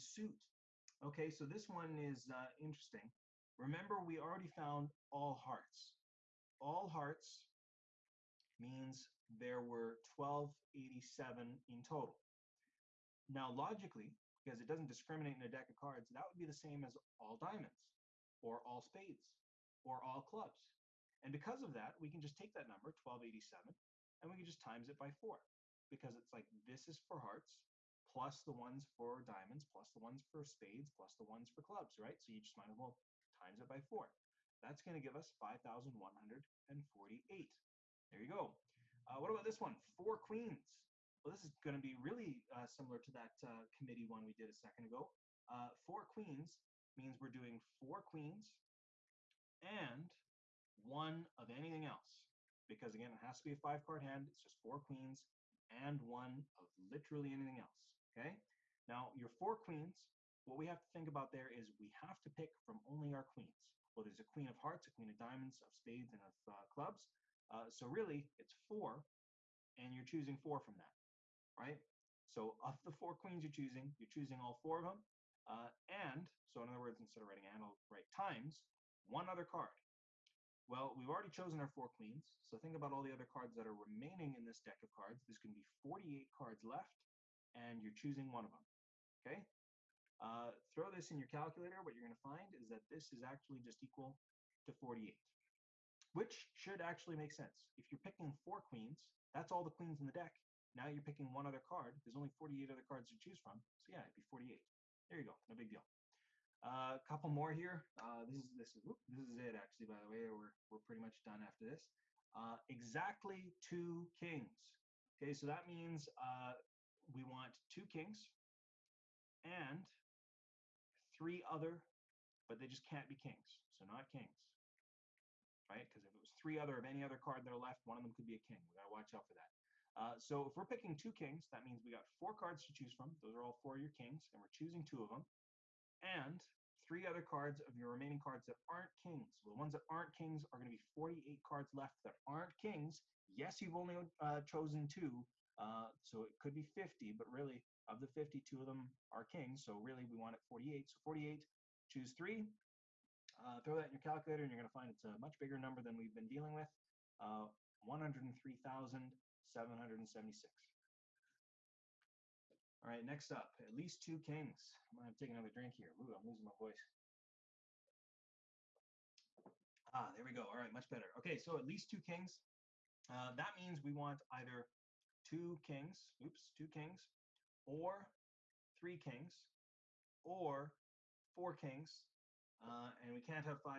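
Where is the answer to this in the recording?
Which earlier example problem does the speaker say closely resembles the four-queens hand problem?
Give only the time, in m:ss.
0:43.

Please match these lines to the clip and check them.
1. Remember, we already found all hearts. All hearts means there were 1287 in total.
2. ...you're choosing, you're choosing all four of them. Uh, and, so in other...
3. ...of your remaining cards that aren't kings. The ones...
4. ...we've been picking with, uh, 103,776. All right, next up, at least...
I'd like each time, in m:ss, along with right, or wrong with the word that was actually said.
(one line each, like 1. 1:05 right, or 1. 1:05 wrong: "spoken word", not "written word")
1. 0:03 right
2. 1:13 right
3. 2:17 right
4. 2:35 wrong: "dealing", not "picking".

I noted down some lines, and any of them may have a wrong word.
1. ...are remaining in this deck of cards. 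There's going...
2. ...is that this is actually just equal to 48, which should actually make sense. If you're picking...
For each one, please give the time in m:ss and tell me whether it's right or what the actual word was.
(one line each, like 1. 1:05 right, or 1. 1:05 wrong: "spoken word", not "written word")
1. 1:23 right
2. 1:32 right.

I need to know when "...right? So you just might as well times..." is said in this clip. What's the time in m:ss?
0:31.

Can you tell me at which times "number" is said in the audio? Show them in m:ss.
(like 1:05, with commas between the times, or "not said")
0:22, 2:35.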